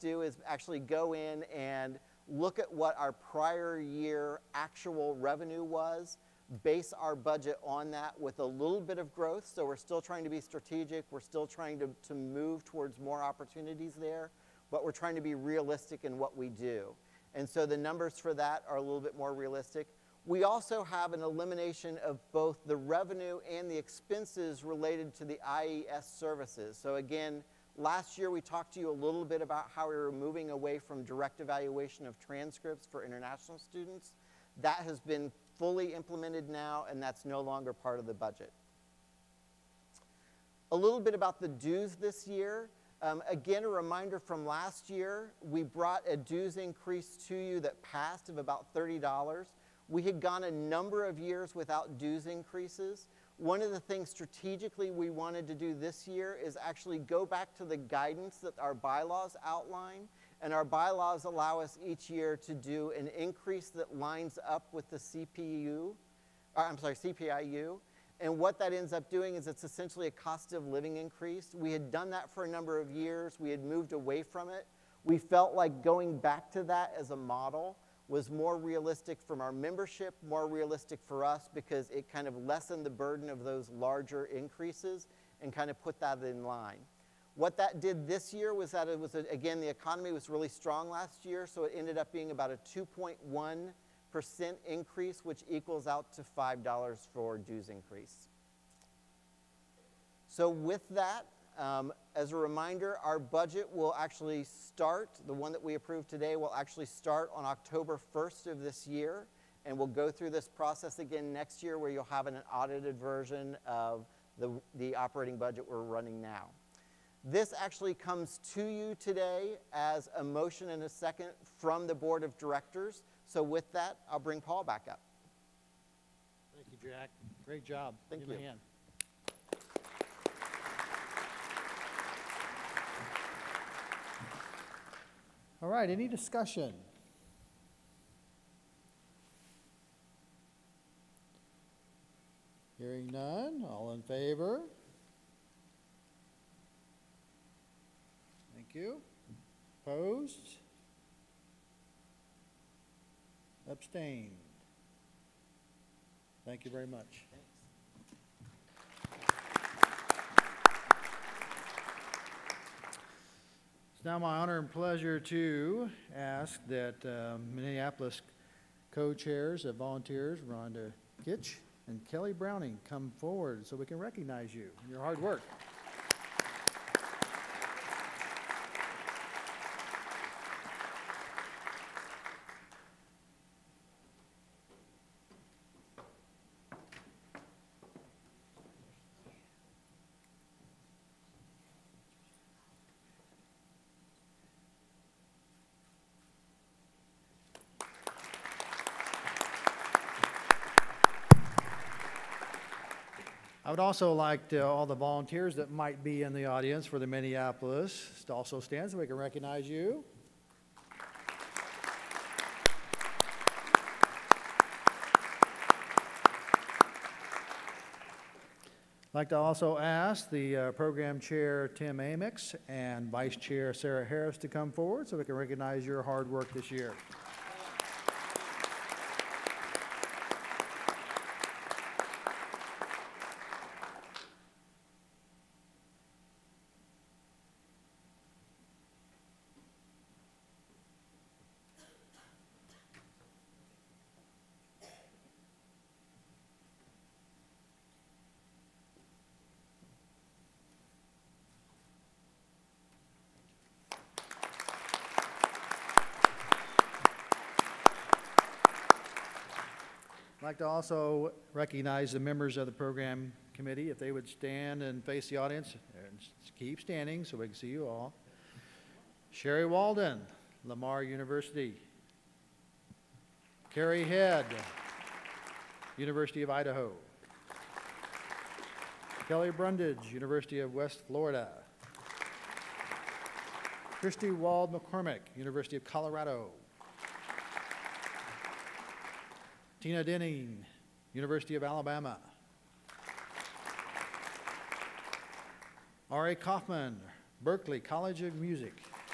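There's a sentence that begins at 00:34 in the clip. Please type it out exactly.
That has been fully implemented now, and that's no longer part of the budget.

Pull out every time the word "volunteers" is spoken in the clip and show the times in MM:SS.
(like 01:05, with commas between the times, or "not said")
02:49, 03:24.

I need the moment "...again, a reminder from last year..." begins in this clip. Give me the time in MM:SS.
00:43.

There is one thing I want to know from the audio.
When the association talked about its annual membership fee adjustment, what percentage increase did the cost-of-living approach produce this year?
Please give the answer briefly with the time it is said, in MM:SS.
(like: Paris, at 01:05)
2.1%, at 01:32.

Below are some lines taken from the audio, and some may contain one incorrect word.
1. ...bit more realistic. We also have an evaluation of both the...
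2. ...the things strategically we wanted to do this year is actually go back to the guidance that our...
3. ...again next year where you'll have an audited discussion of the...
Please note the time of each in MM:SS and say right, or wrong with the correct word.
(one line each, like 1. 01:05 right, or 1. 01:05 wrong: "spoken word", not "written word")
1. 00:18 wrong: "elimination", not "evaluation"
2. 00:53 right
3. 01:50 wrong: "version", not "discussion".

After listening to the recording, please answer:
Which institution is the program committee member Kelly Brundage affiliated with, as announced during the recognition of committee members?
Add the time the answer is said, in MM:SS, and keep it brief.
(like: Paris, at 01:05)
University of West Florida, at 04:40.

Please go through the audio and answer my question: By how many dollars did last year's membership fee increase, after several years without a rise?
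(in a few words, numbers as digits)
$30.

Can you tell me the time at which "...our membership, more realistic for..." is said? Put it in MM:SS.
01:19.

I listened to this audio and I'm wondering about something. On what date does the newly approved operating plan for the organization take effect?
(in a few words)
October 1st.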